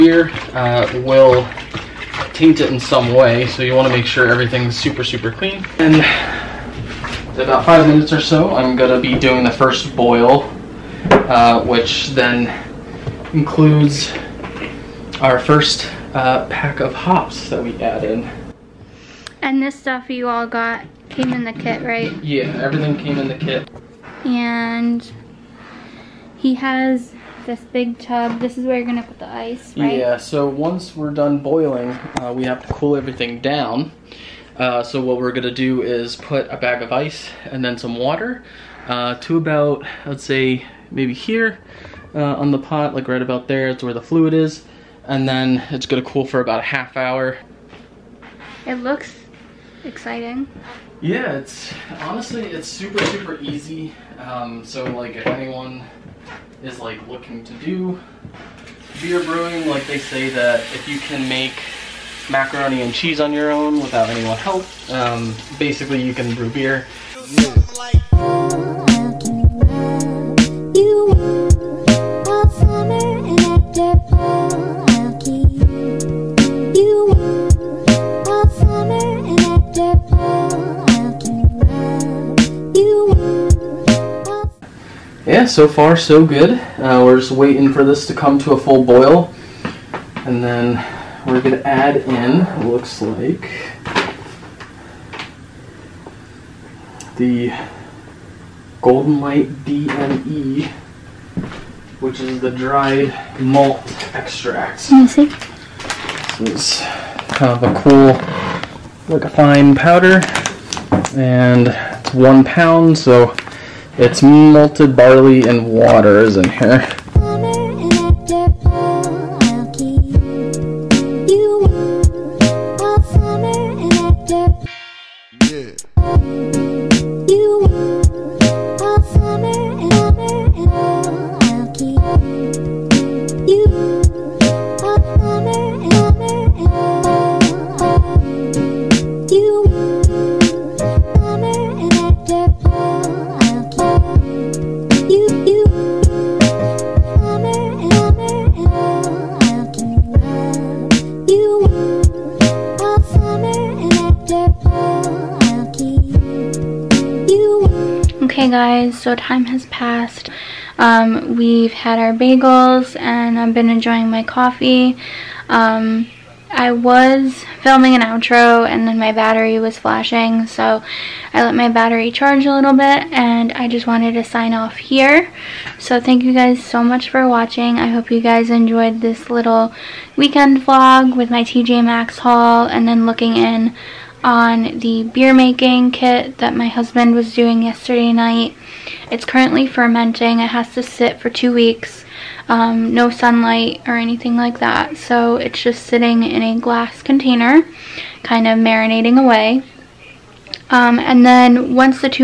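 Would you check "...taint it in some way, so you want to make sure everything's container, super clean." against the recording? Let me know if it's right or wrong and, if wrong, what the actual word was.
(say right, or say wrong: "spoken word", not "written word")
wrong: "super", not "container".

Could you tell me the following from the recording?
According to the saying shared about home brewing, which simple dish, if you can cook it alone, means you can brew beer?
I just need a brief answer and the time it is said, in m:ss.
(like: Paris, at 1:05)
macaroni and cheese, at 1:02.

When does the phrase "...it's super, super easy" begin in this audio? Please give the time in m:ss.
0:52.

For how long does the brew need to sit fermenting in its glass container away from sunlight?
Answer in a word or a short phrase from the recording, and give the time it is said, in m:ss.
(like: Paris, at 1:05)
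2 weeks, at 3:11.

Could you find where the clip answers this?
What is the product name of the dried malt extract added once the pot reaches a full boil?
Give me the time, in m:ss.
1:38.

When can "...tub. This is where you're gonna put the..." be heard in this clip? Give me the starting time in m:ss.
0:27.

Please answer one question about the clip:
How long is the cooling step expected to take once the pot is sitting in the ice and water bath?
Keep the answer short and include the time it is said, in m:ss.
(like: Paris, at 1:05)
half hour, at 0:46.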